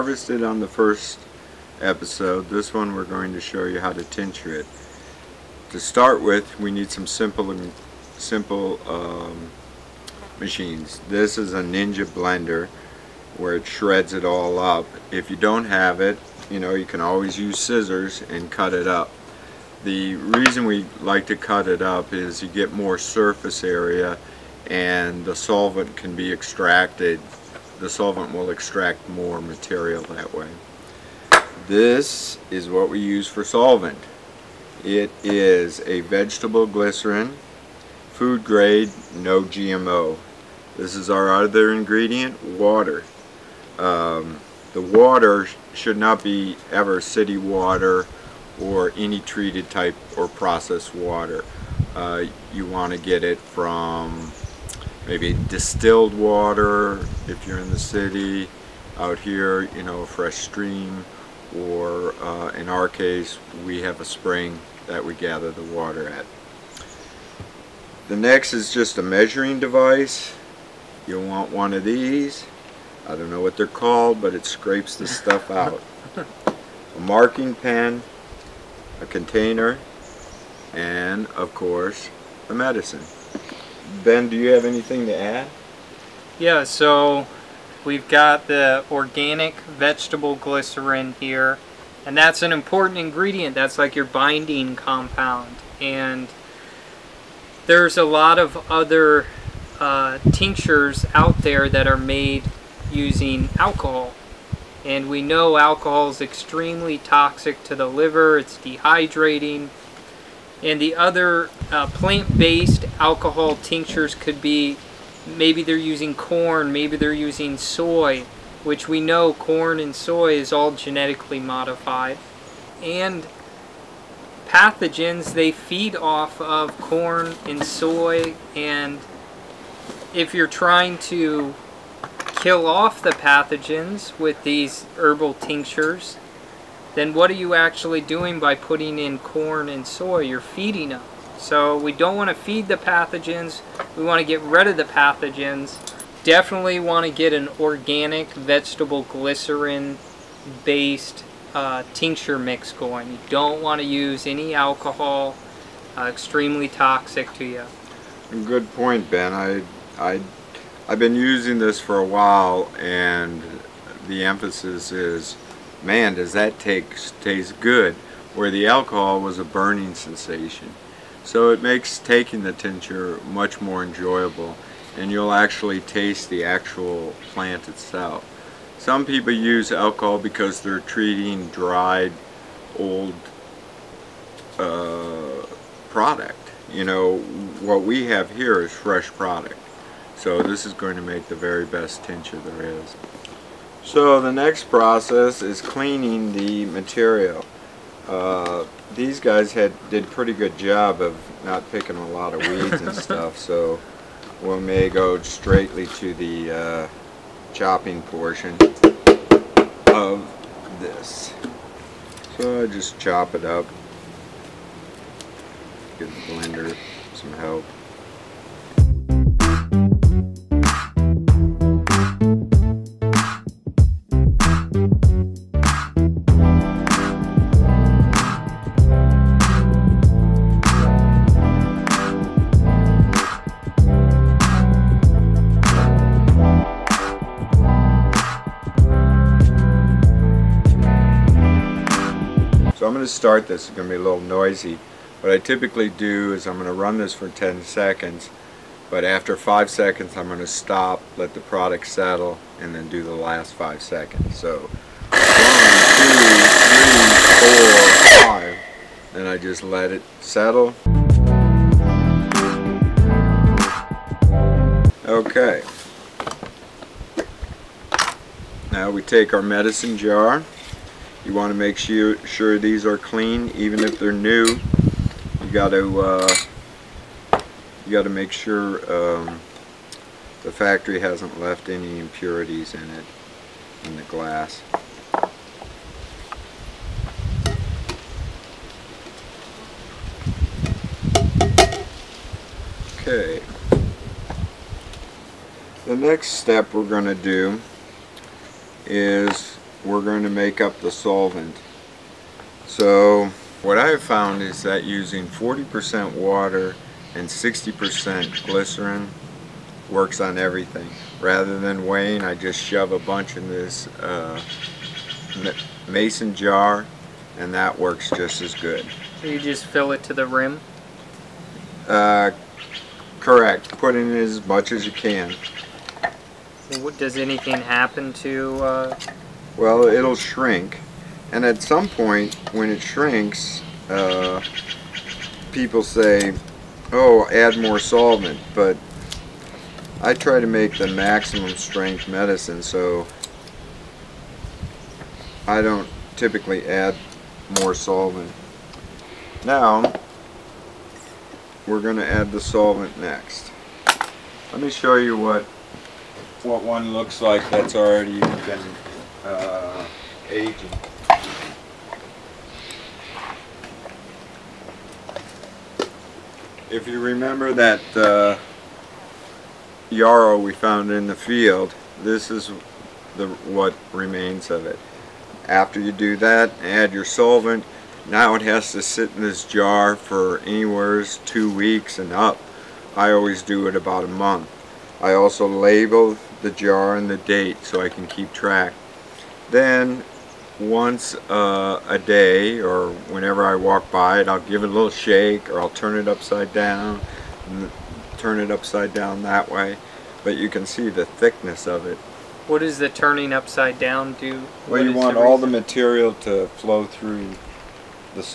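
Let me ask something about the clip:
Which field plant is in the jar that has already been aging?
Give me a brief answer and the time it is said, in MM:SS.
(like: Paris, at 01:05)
yarrow, at 06:09.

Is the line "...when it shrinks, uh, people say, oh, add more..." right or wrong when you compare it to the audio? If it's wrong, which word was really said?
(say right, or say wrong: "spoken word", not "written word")
right.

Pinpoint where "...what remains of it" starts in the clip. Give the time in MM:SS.
06:13.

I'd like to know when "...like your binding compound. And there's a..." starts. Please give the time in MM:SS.
01:33.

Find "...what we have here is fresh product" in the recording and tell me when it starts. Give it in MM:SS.
03:07.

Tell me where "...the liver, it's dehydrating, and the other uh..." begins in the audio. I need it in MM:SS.
01:47.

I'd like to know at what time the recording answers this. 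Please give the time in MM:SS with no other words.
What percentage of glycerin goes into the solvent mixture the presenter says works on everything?
05:07.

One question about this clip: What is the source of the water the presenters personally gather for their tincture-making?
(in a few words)
a spring.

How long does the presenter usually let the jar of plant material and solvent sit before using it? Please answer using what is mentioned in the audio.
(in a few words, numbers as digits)
about a month.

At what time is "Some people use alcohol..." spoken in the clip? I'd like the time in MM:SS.
02:58.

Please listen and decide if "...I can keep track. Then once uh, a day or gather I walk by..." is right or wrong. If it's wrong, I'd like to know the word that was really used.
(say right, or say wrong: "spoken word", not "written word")
wrong: "whenever", not "gather".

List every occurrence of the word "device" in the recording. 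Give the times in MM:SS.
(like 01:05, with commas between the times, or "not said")
01:09.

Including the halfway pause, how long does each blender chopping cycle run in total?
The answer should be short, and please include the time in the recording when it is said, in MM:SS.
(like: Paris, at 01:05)
10 seconds, at 04:07.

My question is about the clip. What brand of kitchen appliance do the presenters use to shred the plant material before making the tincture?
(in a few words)
Ninja.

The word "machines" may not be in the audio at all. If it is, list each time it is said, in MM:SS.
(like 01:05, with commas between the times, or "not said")
00:10.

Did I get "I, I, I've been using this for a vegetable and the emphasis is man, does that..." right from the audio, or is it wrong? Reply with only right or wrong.
wrong.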